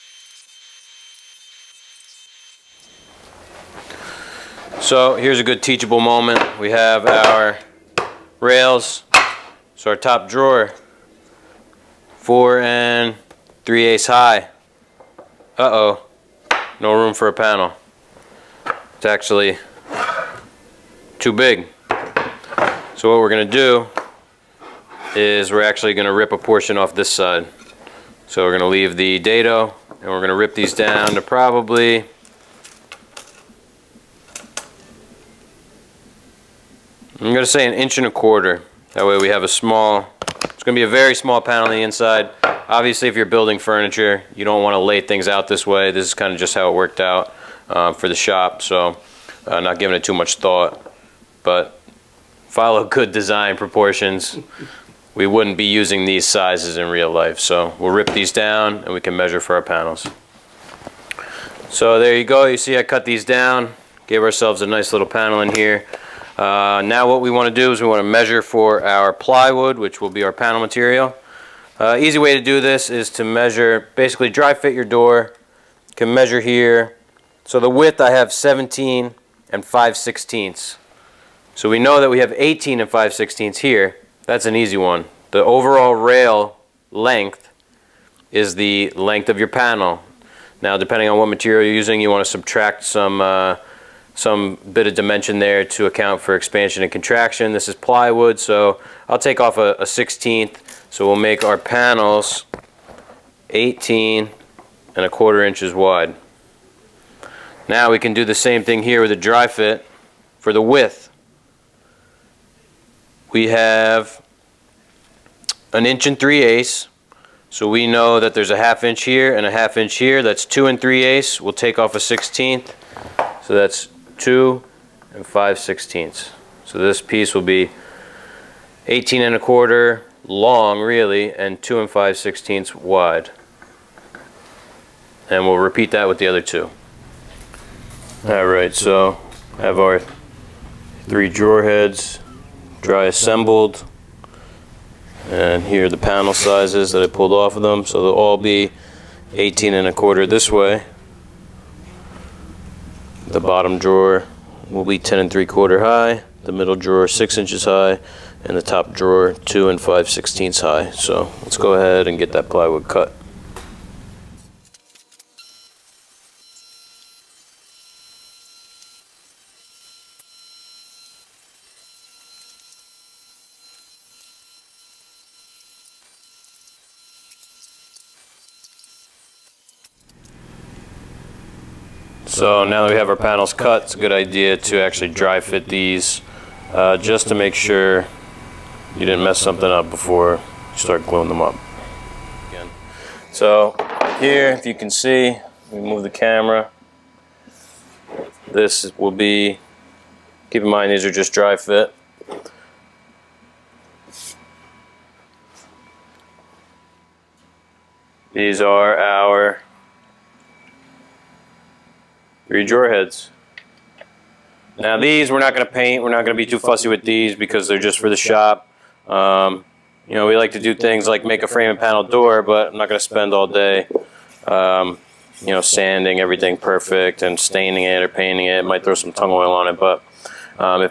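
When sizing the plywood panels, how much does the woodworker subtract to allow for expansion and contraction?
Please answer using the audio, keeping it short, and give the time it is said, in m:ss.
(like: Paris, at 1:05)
1/16 inch, at 1:39.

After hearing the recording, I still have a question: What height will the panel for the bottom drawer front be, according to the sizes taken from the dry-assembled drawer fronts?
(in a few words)
10 3/4 inches.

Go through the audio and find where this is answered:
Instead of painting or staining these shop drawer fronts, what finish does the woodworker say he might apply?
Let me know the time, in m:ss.
3:49.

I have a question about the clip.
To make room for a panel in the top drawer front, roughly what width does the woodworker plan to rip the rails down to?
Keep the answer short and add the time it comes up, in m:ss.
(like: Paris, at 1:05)
1 1/4 inches, at 0:37.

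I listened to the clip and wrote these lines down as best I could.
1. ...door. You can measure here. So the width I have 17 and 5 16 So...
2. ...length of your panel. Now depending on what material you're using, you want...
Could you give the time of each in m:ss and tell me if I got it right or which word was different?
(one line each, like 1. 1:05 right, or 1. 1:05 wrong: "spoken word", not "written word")
1. 1:14 right
2. 1:28 right.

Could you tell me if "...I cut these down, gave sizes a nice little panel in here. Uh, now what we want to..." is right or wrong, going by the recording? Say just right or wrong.
wrong.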